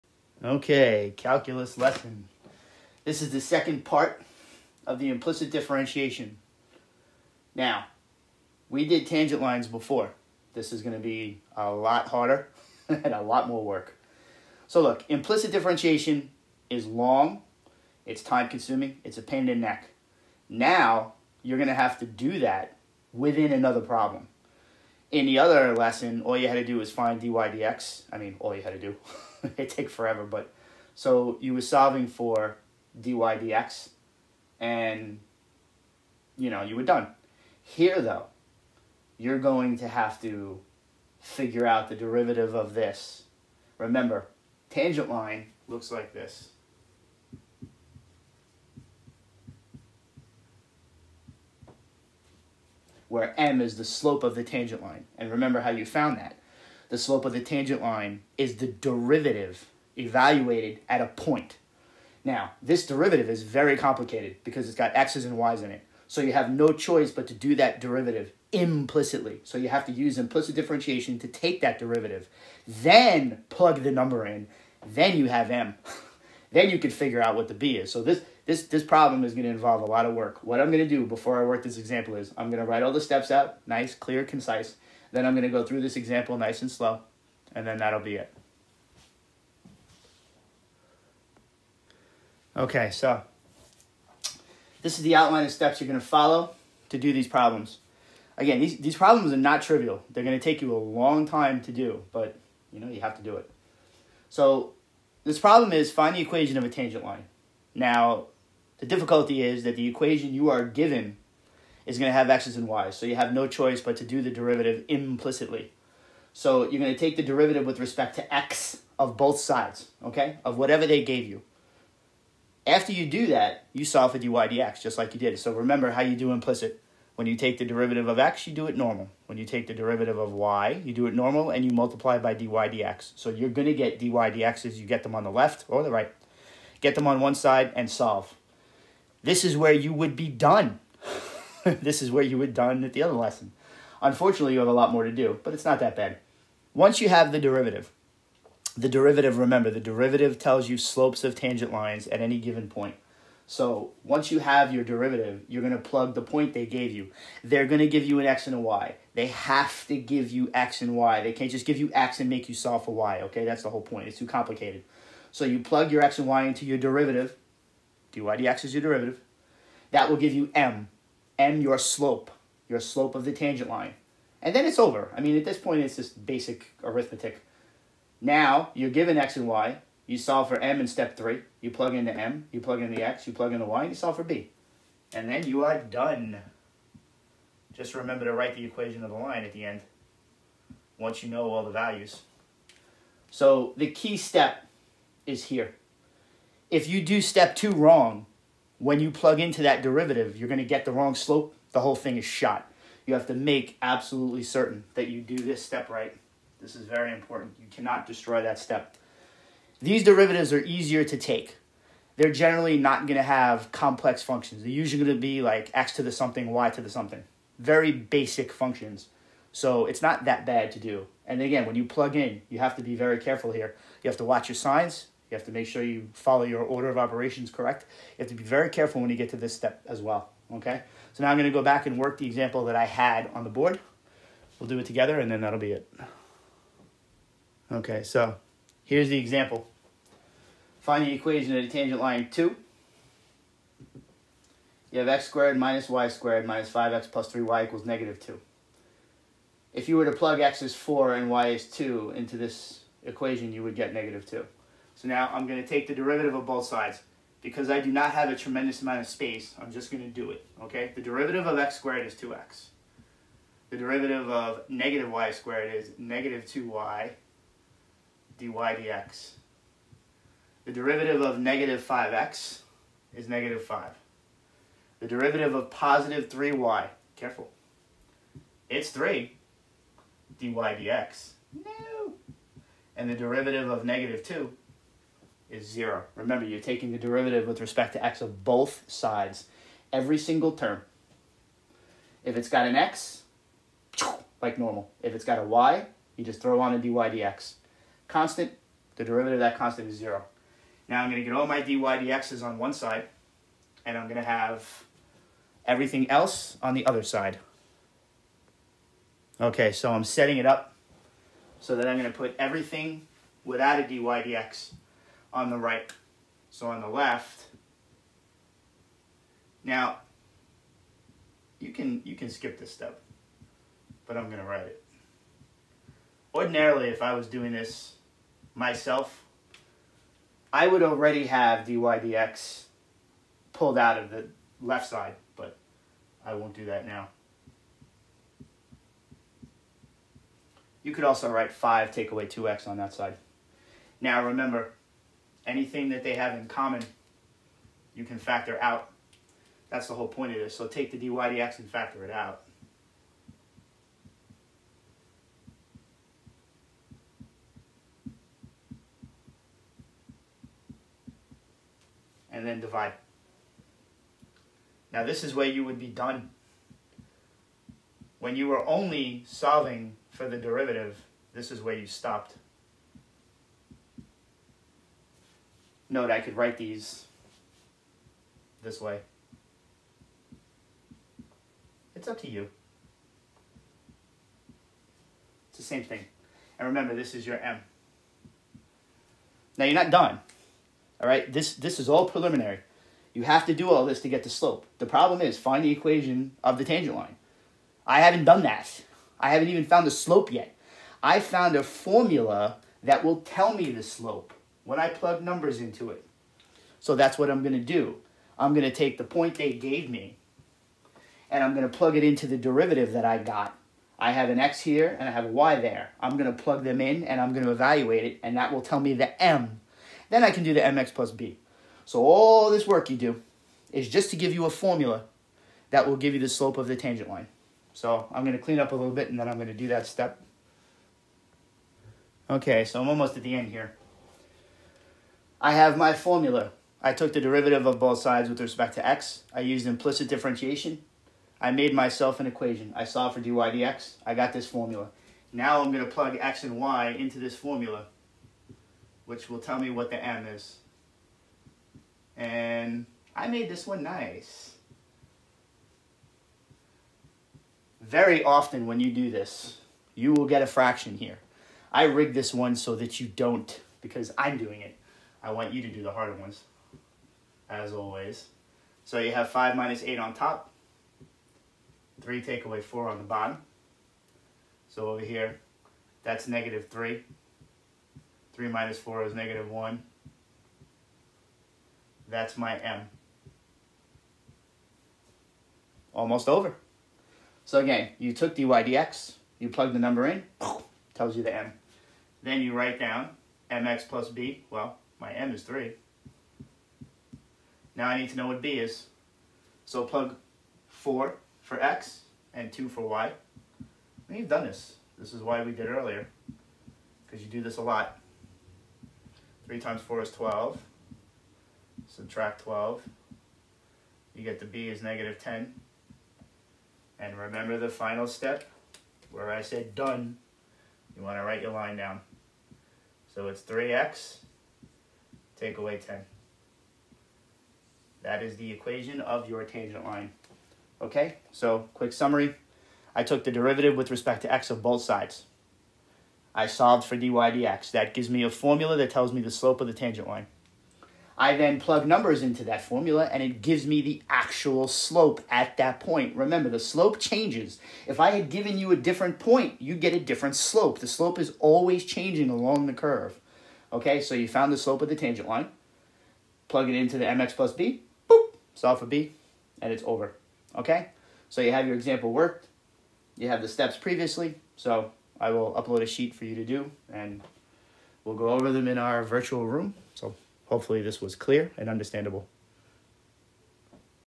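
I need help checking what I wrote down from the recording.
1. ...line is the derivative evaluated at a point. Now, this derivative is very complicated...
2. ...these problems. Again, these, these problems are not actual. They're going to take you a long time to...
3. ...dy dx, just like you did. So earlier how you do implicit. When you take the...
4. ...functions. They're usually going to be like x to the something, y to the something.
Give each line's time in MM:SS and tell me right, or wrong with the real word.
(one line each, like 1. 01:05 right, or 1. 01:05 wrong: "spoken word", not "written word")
1. 00:57 right
2. 01:37 wrong: "trivial", not "actual"
3. 02:04 wrong: "remember", not "earlier"
4. 03:34 right.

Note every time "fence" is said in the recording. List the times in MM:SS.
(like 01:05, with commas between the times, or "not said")
not said.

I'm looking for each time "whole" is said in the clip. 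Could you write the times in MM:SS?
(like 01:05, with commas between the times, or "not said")
02:43, 03:21, 05:49.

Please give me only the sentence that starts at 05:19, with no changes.
Now, you can, you can skip this step, but I'm going to write it.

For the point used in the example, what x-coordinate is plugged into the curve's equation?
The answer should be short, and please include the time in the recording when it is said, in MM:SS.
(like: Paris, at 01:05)
4, at 04:10.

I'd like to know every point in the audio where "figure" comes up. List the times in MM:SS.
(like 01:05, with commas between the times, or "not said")
00:41, 01:16.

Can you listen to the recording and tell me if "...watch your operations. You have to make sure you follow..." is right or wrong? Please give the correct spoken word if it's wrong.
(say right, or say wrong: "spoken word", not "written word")
wrong: "signs", not "operations".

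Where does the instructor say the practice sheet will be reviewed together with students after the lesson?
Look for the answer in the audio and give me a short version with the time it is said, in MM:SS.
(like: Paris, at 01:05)
virtual room, at 09:29.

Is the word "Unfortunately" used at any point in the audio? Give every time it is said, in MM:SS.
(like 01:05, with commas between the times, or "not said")
02:24.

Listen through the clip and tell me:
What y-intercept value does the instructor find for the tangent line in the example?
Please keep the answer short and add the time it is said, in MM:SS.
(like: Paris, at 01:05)
-10, at 08:34.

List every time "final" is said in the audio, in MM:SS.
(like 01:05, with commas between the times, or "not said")
08:37.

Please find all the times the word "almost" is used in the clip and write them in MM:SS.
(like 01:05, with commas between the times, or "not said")
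07:12, 08:05.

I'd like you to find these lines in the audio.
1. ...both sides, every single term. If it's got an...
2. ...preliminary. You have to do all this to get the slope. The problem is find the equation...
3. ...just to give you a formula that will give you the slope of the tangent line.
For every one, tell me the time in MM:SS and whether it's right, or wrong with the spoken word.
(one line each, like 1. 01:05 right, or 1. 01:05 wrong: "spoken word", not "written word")
1. 04:48 right
2. 06:32 right
3. 07:03 right.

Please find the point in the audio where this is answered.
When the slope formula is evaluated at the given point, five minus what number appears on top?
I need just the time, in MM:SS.
07:49.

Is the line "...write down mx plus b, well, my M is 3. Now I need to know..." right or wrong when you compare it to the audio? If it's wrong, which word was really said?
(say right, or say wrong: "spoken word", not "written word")
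right.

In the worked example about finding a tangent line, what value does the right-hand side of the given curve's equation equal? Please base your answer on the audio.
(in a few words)
-2.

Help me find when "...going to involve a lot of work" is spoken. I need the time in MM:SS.
01:19.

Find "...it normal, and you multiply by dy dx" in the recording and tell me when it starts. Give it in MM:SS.
02:11.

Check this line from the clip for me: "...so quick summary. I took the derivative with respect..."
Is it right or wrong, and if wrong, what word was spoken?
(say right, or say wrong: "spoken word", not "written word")
right.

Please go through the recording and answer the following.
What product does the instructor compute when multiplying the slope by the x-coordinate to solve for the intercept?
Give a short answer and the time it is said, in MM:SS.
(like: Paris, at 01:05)
12, at 08:29.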